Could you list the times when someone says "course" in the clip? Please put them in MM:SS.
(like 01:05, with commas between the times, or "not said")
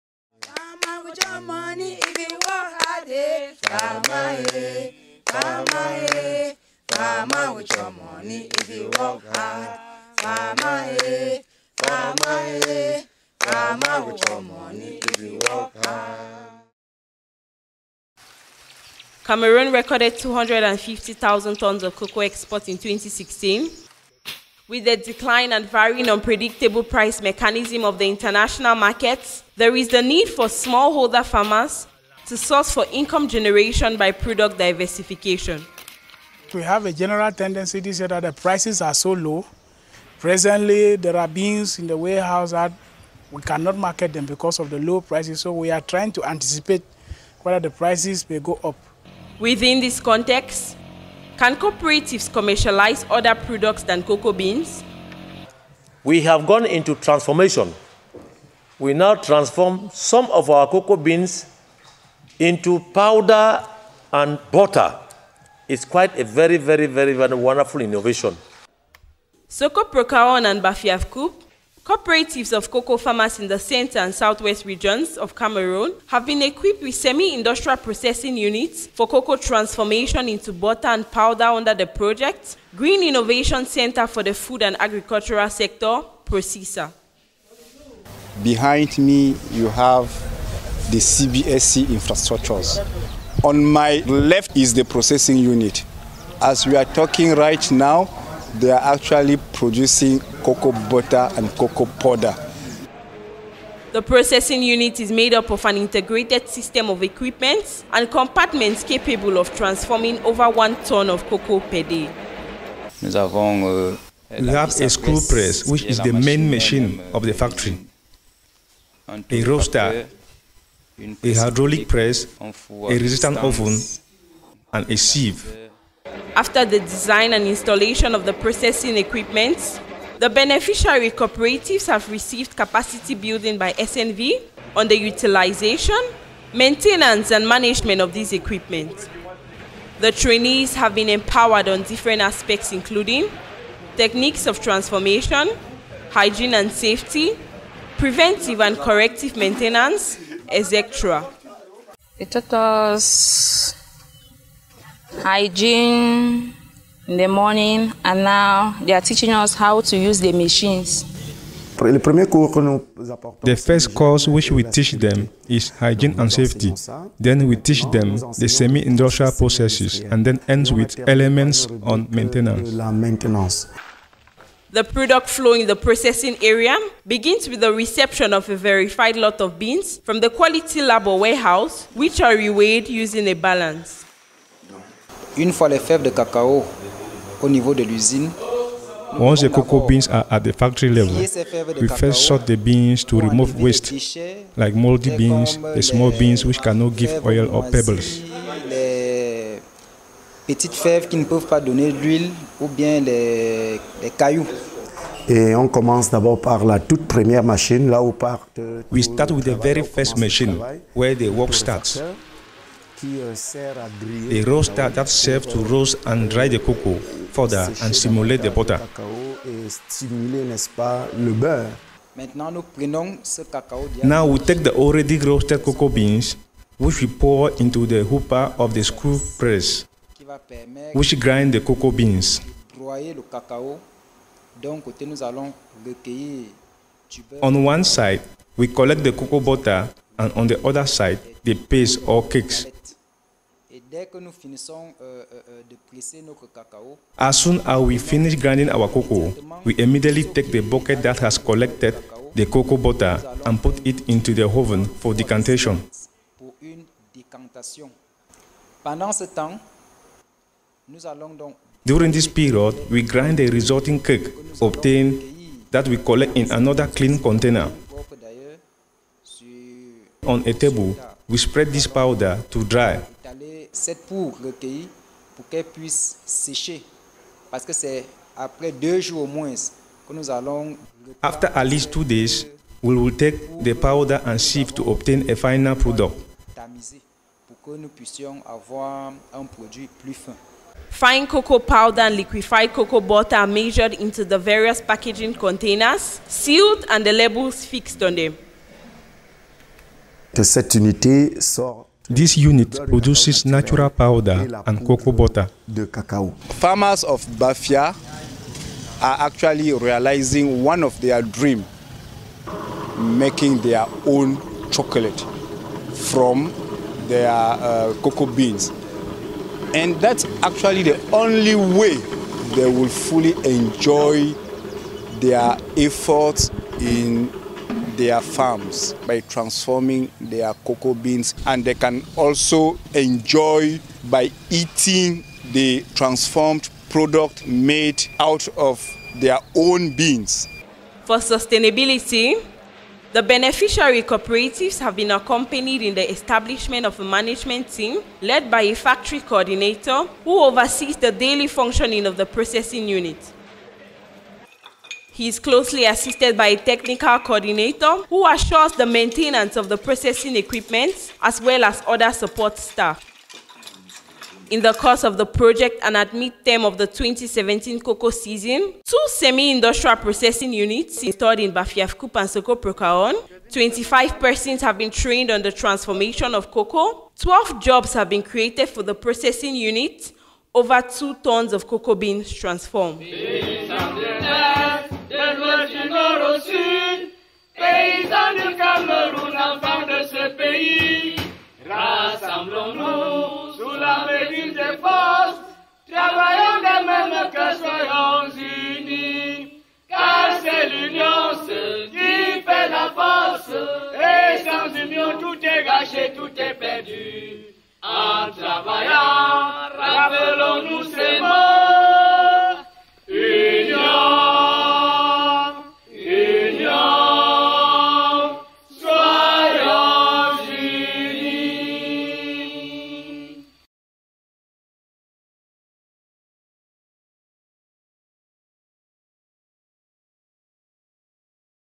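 02:43, 06:04.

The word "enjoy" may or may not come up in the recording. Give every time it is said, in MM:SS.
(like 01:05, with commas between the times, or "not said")
05:23, 05:32.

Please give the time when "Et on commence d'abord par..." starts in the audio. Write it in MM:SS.
03:25.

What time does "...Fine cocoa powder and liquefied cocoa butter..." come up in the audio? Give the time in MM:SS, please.
04:50.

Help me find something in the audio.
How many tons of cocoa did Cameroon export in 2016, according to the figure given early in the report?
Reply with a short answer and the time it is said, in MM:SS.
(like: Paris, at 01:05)
250,000 tons, at 00:20.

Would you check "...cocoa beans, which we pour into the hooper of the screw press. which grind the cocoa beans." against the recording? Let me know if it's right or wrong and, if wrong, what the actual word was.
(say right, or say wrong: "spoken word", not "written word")
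right.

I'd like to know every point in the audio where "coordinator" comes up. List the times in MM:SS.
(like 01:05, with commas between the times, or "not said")
05:49, 05:57.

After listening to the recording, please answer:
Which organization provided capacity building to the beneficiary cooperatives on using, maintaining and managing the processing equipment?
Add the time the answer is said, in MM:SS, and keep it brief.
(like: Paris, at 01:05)
SNV, at 02:13.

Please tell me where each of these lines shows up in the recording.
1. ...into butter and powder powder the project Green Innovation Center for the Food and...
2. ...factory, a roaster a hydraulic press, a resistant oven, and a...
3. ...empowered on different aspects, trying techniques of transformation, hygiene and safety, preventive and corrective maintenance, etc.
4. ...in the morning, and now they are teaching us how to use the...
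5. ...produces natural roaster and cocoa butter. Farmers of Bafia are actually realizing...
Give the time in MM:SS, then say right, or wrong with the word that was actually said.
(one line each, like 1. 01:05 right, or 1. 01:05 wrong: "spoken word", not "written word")
1. 01:20 wrong: "under", not "powder"
2. 01:57 right
3. 02:21 wrong: "including", not "trying"
4. 02:37 right
5. 05:02 wrong: "powder", not "roaster".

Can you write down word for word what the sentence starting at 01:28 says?
Behind me, you have the CBSC infrastructures.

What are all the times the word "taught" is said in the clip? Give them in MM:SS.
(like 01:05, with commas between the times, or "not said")
02:32.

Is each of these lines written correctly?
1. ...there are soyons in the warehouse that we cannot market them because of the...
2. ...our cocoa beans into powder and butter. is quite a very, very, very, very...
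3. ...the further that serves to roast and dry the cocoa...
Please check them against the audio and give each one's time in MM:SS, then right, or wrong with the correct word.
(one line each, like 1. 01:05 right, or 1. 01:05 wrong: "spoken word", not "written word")
1. 00:40 wrong: "beans", not "soyons"
2. 01:00 right
3. 03:34 wrong: "roaster", not "further".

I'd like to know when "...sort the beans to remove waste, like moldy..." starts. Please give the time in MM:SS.
03:12.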